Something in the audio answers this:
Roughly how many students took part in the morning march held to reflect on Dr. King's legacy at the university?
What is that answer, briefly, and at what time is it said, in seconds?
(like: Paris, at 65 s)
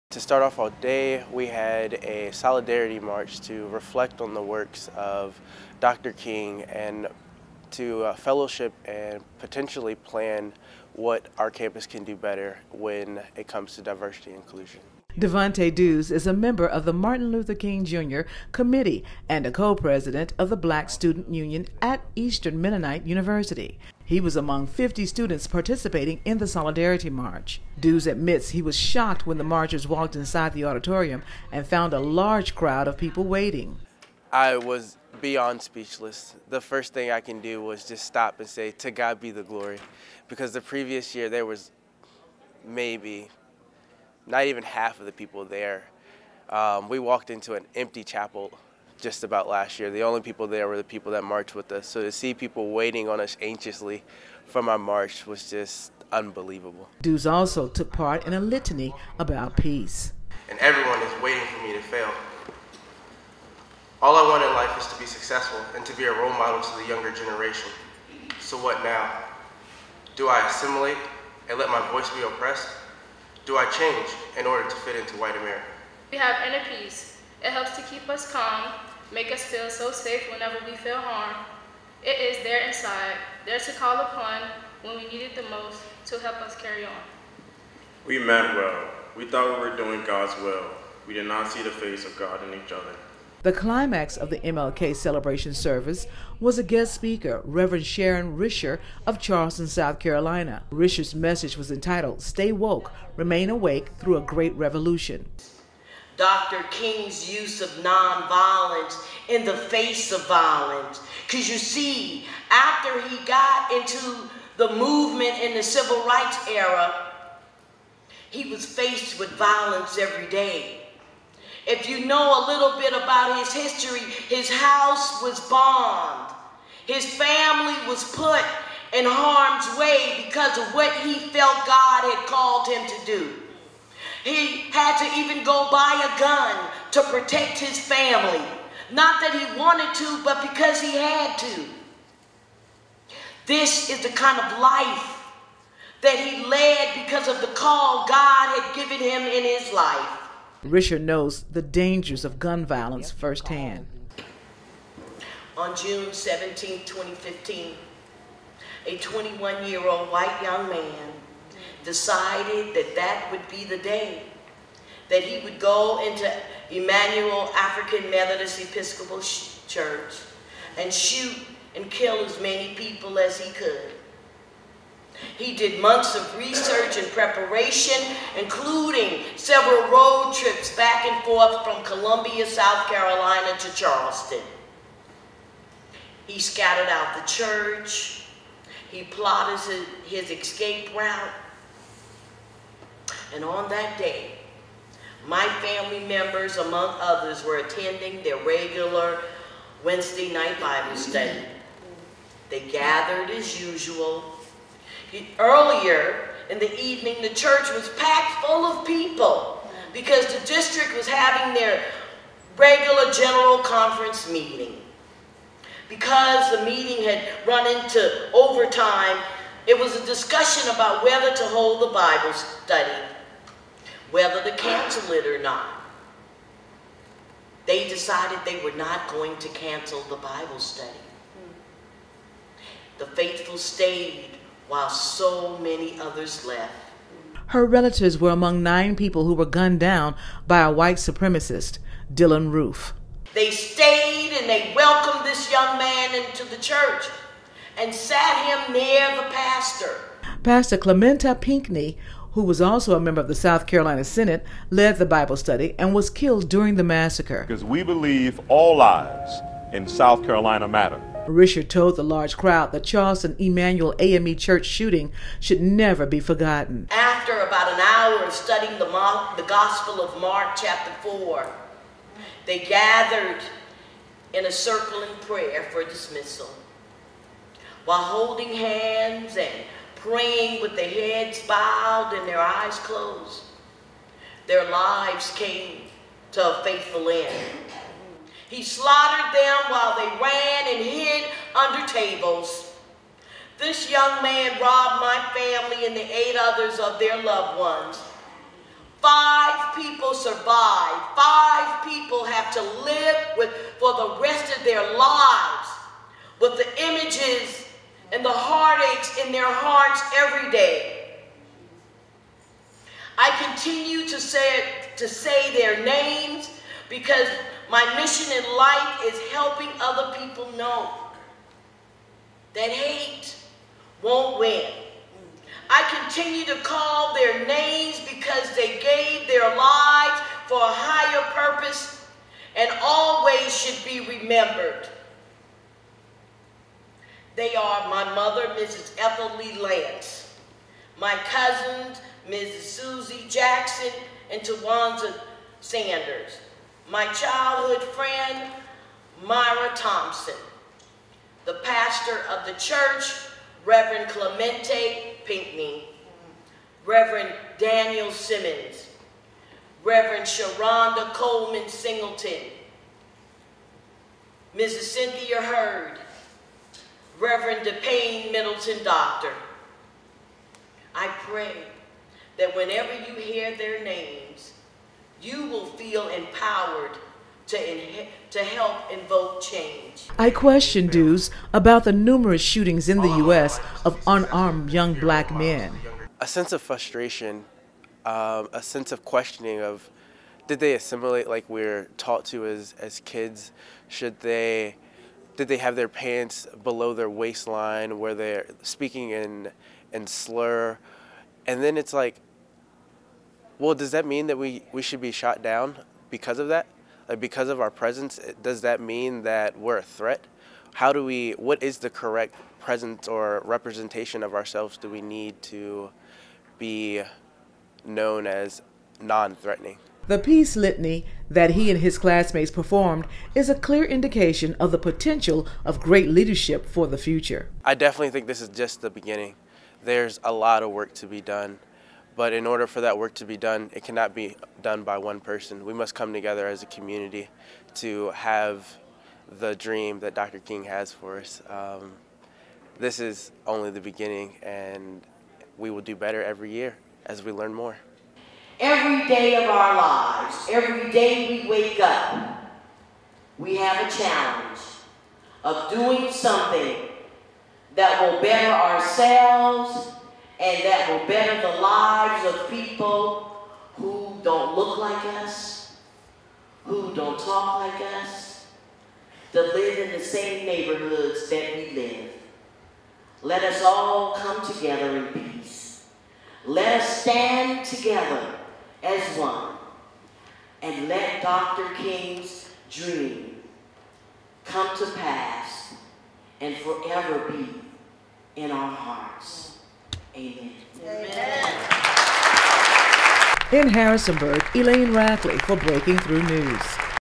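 50, at 24 s.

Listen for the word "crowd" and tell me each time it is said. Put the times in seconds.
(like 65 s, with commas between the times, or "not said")
32 s, 262 s.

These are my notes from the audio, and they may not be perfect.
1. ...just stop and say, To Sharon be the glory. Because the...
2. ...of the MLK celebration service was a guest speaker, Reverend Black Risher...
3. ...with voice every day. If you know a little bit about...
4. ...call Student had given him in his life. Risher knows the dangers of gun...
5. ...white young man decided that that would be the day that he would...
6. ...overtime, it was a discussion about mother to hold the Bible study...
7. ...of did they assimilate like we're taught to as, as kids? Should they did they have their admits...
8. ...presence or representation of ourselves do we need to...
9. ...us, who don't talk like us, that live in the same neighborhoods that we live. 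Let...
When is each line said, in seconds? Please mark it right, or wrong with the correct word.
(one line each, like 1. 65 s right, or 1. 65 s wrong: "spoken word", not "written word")
1. 37 s wrong: "God", not "Sharon"
2. 94 s wrong: "Sharon", not "Black"
3. 119 s wrong: "violence", not "voice"
4. 147 s wrong: "God", not "Student"
5. 160 s right
6. 218 s wrong: "whether", not "mother"
7. 389 s wrong: "pants", not "admits"
8. 412 s right
9. 465 s right.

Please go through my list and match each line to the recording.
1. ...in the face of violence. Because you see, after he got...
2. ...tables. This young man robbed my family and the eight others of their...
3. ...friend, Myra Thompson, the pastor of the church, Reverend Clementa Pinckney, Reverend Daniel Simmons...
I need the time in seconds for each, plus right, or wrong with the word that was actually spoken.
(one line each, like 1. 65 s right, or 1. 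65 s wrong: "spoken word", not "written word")
1. 109 s right
2. 291 s right
3. 347 s right.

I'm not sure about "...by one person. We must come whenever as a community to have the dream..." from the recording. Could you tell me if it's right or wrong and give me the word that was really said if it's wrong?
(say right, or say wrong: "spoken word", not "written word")
wrong: "together", not "whenever".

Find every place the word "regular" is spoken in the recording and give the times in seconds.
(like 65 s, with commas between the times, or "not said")
198 s, 212 s.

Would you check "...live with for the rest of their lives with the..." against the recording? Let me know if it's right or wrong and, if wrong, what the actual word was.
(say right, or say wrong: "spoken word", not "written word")
right.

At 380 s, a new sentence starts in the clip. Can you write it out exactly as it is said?
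I question Dews about the numerous shootings in the U.S.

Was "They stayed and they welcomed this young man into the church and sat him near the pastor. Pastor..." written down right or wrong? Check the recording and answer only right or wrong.
right.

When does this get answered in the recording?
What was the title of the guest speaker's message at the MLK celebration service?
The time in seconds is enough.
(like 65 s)
102 s.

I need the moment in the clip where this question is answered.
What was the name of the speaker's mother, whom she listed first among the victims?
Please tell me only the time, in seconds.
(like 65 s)
338 s.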